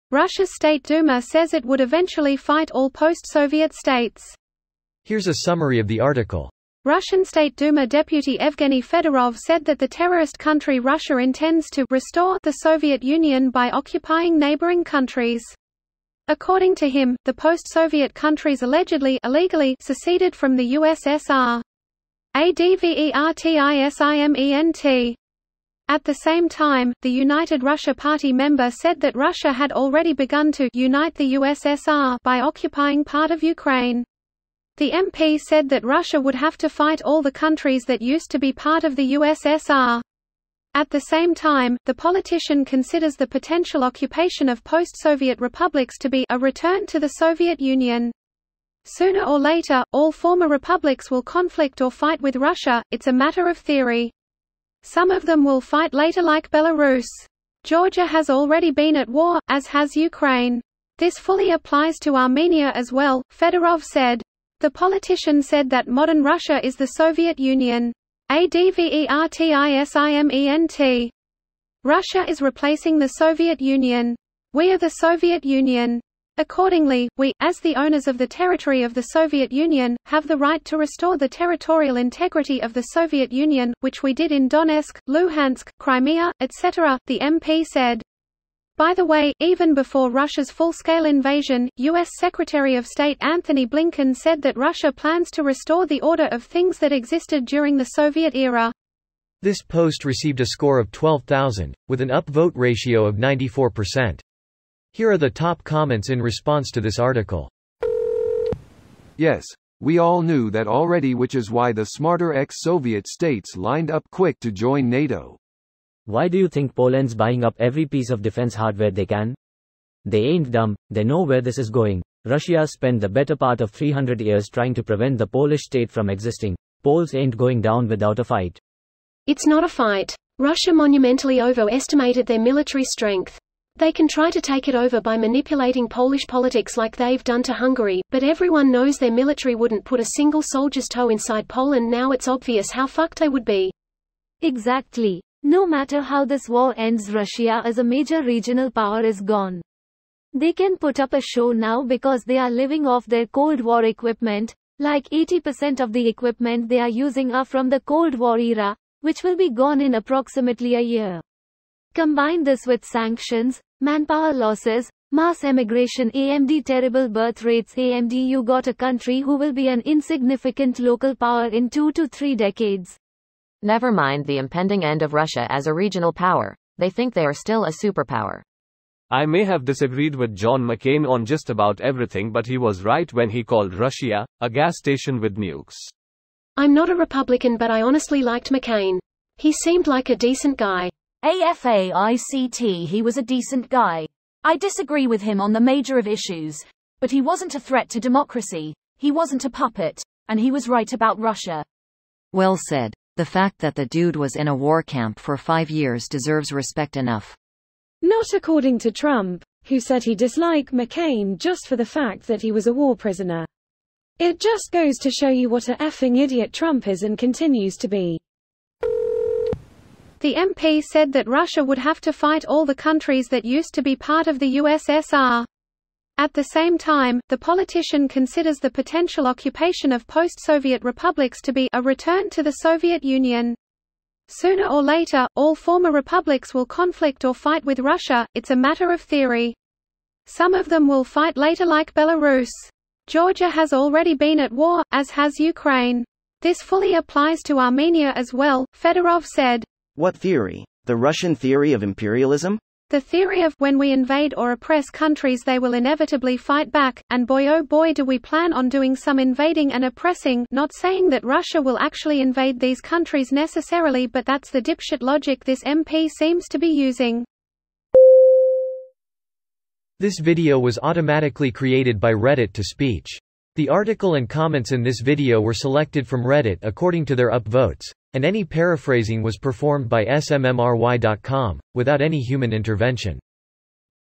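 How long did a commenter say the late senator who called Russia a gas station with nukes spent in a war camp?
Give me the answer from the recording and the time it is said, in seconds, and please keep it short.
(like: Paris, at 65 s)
5 years, at 205 s.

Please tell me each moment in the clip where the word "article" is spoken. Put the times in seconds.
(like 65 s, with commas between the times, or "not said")
6 s, 106 s, 273 s.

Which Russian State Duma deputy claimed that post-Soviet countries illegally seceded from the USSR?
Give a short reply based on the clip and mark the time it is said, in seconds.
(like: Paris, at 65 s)
Evgeny Fedorov, at 8 s.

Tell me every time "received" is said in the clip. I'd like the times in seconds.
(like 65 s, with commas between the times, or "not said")
100 s.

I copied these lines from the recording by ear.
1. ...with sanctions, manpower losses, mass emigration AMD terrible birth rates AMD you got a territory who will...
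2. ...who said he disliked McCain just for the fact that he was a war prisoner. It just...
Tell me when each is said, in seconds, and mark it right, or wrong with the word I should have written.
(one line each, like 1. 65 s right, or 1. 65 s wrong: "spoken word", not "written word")
1. 162 s wrong: "country", not "territory"
2. 209 s right.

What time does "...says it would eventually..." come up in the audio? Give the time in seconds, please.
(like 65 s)
1 s.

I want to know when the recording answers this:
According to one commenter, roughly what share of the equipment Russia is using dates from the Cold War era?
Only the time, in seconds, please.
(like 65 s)
155 s.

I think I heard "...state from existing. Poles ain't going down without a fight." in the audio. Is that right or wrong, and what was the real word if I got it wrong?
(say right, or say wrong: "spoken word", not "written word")
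right.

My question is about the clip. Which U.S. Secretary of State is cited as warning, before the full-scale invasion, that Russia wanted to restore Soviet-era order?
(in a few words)
Anthony Blinken.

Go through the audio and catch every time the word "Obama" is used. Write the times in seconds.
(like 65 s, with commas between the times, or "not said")
not said.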